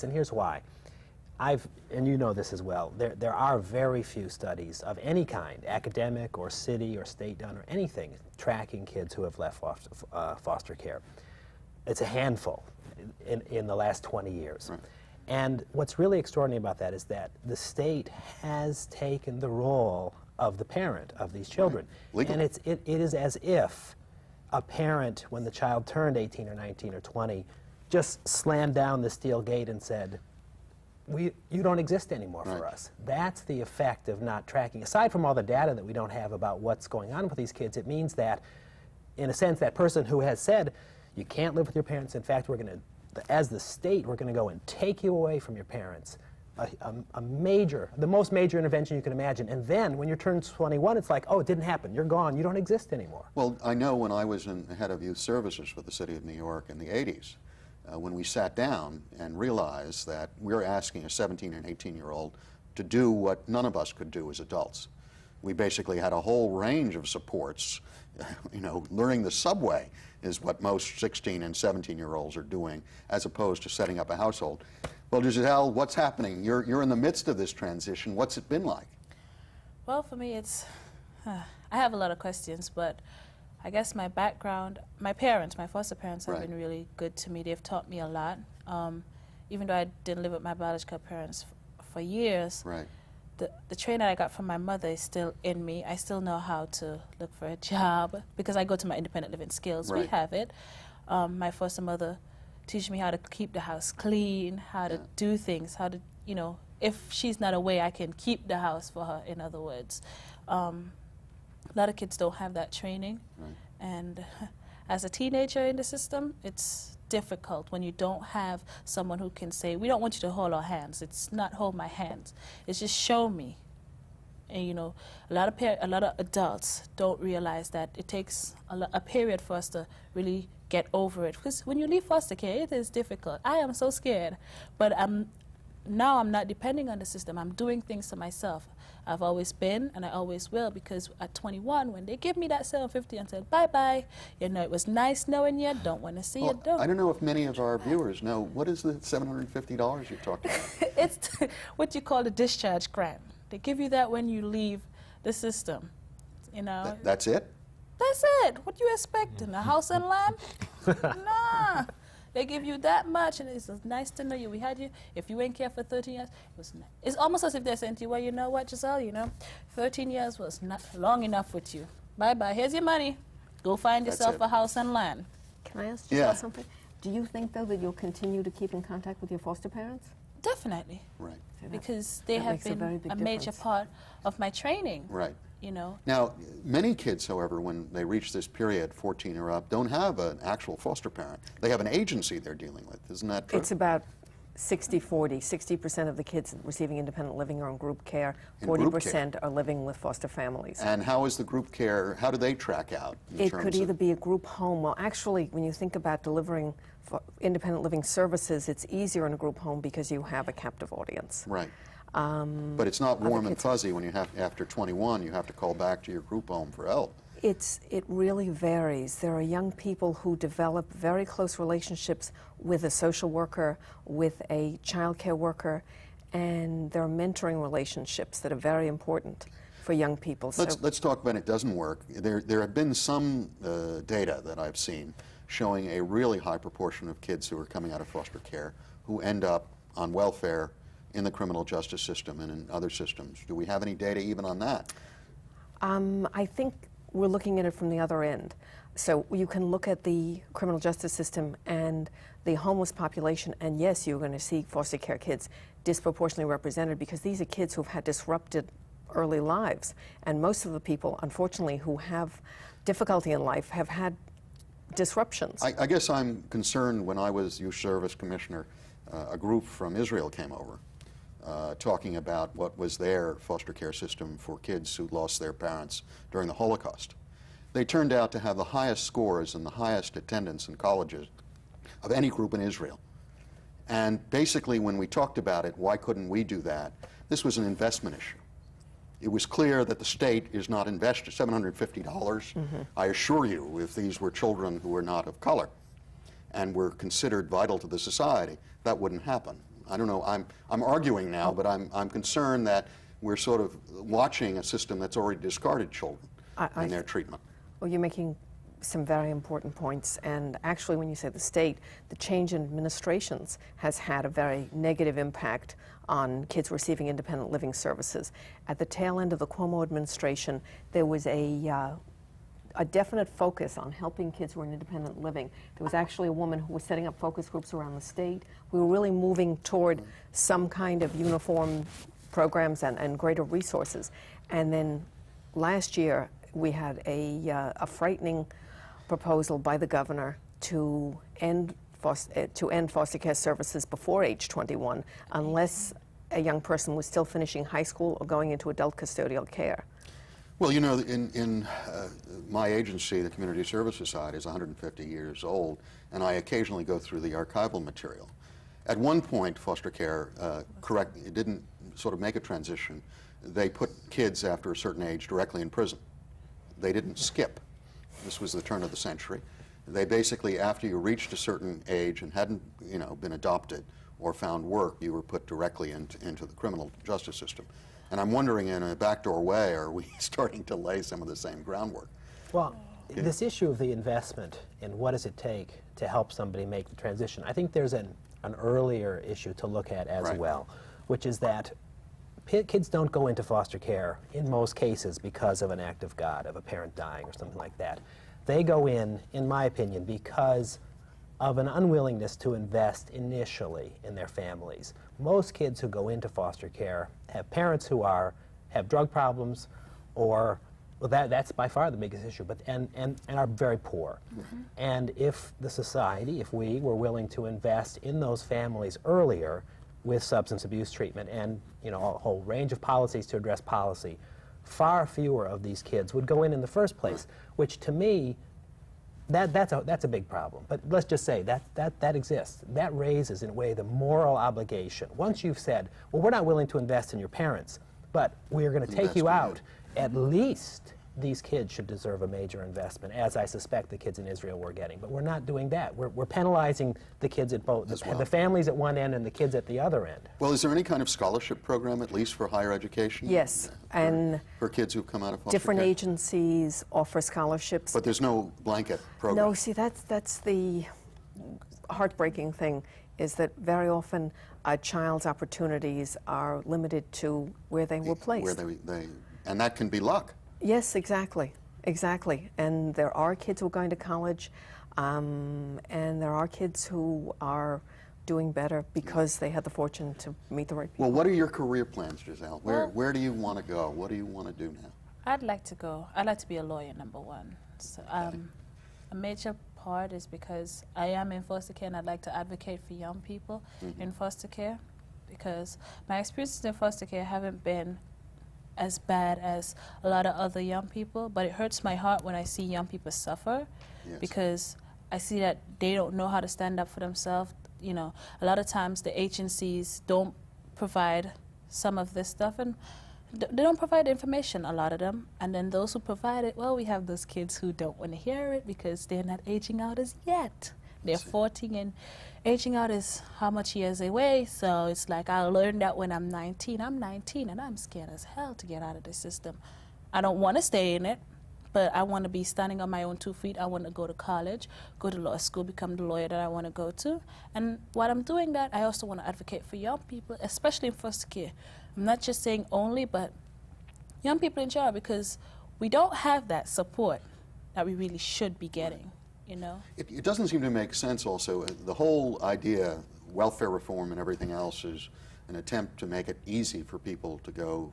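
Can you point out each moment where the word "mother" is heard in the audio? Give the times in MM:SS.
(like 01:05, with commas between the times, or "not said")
01:34, 01:41.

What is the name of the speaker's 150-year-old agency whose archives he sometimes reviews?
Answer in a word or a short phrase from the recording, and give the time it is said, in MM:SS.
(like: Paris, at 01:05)
Community Service Society, at 05:53.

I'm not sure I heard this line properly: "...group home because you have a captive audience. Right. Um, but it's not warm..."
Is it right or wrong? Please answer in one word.
right.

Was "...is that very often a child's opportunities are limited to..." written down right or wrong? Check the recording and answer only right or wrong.
right.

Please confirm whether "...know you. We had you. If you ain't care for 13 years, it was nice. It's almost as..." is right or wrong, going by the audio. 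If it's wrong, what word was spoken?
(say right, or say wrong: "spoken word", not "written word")
right.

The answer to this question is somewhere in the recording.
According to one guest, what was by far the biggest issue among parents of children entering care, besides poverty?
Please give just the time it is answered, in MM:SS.
06:48.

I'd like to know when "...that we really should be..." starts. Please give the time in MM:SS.
09:07.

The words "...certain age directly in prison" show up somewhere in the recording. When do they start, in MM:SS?
06:04.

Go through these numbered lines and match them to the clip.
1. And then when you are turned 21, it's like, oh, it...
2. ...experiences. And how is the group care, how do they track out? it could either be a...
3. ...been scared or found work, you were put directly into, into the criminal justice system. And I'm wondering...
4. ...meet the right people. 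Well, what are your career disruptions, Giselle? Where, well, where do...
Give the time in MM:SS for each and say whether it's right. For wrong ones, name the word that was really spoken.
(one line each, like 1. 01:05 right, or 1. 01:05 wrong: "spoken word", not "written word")
1. 00:49 right
2. 03:20 wrong: "families", not "experiences"
3. 06:13 wrong: "adopted", not "scared"
4. 08:00 wrong: "plans", not "disruptions".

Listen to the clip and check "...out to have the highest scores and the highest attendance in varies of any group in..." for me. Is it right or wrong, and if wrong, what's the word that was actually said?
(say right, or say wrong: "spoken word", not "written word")
wrong: "colleges", not "varies".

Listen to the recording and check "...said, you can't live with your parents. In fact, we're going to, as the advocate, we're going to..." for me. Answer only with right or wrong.
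wrong.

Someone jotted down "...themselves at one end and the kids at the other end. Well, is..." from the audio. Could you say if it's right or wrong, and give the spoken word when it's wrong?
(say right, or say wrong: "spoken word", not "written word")
wrong: "families", not "themselves".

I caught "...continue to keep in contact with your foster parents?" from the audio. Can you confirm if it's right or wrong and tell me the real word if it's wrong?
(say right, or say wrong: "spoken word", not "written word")
right.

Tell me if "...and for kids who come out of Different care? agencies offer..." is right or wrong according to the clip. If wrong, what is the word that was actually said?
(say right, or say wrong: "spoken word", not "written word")
right.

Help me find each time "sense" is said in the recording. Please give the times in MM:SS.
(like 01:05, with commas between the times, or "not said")
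00:39, 09:10.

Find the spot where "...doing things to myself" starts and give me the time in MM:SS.
02:17.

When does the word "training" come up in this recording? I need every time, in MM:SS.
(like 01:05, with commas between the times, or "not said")
01:33, 01:52, 03:04.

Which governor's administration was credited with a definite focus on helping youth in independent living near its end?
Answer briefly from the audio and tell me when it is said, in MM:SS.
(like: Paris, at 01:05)
Cuomo, at 05:19.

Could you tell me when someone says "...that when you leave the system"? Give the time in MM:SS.
02:33.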